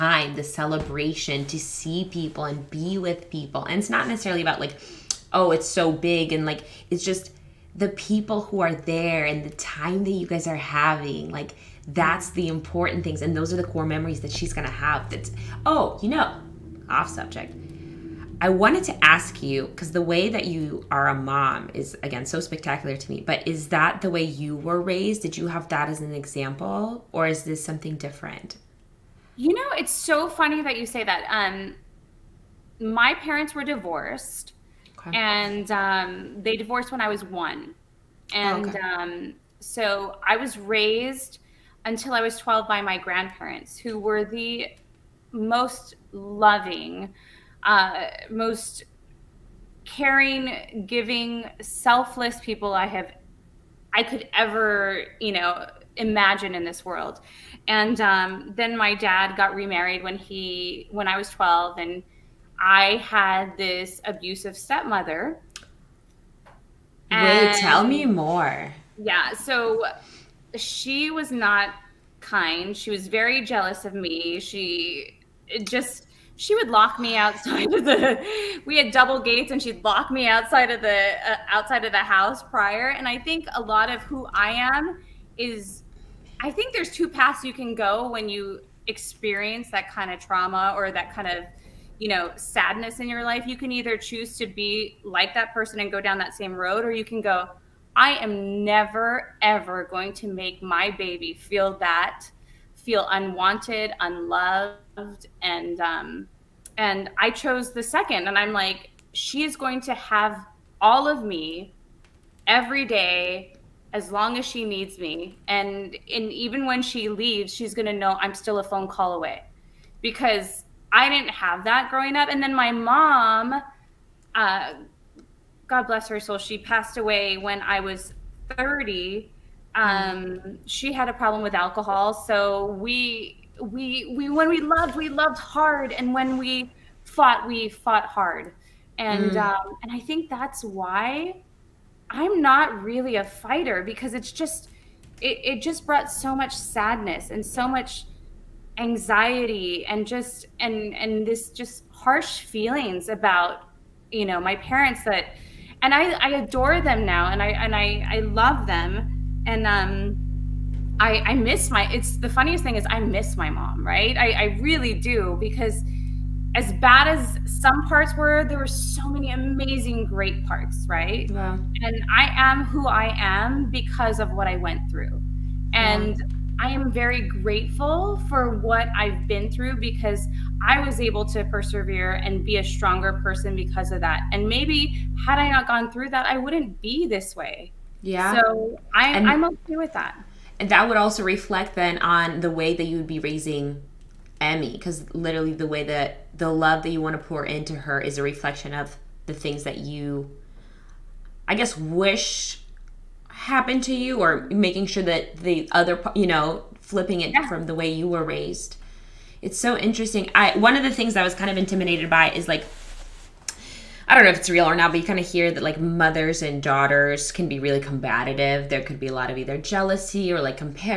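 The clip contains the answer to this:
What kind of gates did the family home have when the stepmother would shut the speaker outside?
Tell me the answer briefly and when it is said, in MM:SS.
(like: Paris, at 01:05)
Double gates, at 01:18.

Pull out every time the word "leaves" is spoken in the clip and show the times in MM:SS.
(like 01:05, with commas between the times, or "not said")
01:57.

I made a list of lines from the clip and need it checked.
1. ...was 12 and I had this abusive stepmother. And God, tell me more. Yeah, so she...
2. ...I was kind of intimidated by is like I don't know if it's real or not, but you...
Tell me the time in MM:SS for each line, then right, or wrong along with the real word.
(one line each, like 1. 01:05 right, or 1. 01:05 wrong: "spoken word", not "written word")
1. 01:01 wrong: "Wait", not "God"
2. 03:31 right.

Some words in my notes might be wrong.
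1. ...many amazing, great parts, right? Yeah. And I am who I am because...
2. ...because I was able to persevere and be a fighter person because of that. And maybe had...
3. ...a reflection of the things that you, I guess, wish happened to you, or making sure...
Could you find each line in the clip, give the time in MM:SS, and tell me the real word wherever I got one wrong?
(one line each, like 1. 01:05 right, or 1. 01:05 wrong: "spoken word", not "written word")
1. 02:49 right
2. 02:59 wrong: "stronger", not "fighter"
3. 03:18 right.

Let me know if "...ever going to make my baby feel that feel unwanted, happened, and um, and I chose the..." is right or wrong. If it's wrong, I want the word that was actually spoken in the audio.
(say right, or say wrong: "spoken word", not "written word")
wrong: "unloved", not "happened".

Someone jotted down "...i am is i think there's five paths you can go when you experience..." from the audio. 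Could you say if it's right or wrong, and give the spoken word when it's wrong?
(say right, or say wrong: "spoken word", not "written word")
wrong: "two", not "five".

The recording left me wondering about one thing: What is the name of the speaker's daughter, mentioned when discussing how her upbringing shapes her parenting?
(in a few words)
Emmy.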